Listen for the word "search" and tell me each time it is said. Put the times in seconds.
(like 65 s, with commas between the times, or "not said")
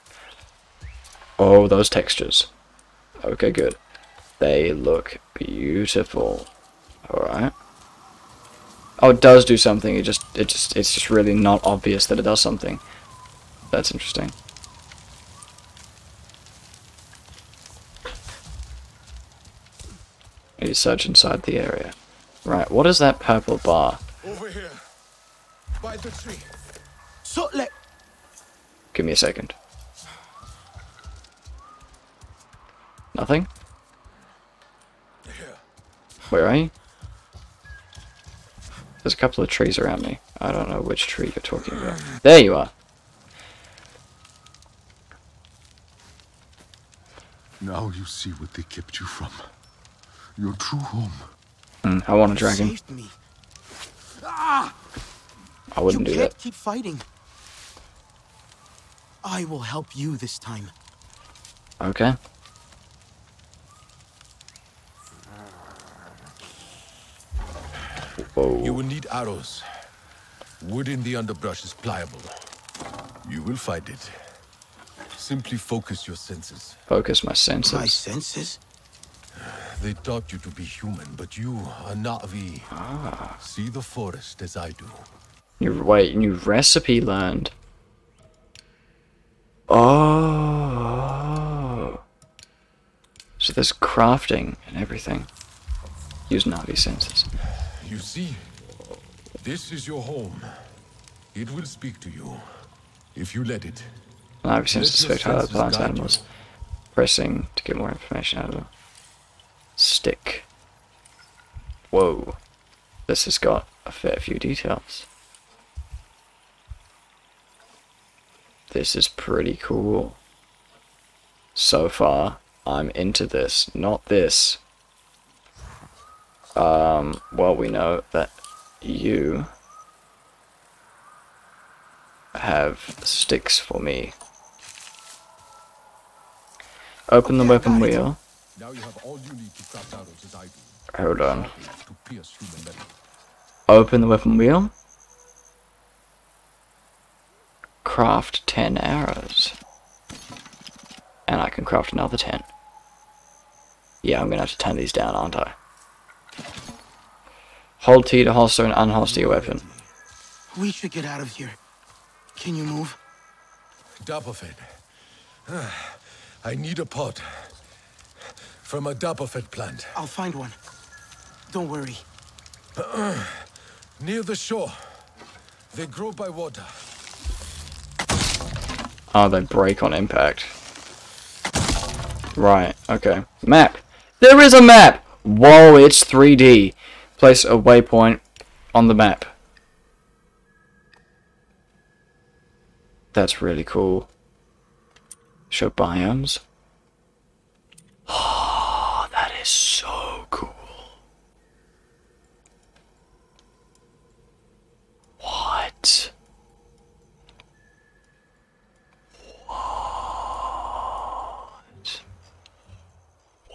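20 s.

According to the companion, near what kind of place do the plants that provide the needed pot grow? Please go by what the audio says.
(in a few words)
Near the shore.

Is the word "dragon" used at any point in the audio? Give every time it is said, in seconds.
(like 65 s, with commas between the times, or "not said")
52 s.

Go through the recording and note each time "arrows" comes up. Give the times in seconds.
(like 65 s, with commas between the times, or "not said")
69 s, 148 s.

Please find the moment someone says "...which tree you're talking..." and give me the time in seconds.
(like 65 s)
40 s.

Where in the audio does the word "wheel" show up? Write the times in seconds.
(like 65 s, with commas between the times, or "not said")
137 s, 144 s.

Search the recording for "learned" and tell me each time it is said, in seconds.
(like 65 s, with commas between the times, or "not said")
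87 s.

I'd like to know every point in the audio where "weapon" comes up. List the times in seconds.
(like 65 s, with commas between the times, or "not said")
137 s, 144 s, 159 s.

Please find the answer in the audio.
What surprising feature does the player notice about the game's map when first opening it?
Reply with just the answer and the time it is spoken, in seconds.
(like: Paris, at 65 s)
It's 3D, at 185 s.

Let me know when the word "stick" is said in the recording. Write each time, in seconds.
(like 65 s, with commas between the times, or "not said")
109 s, 133 s.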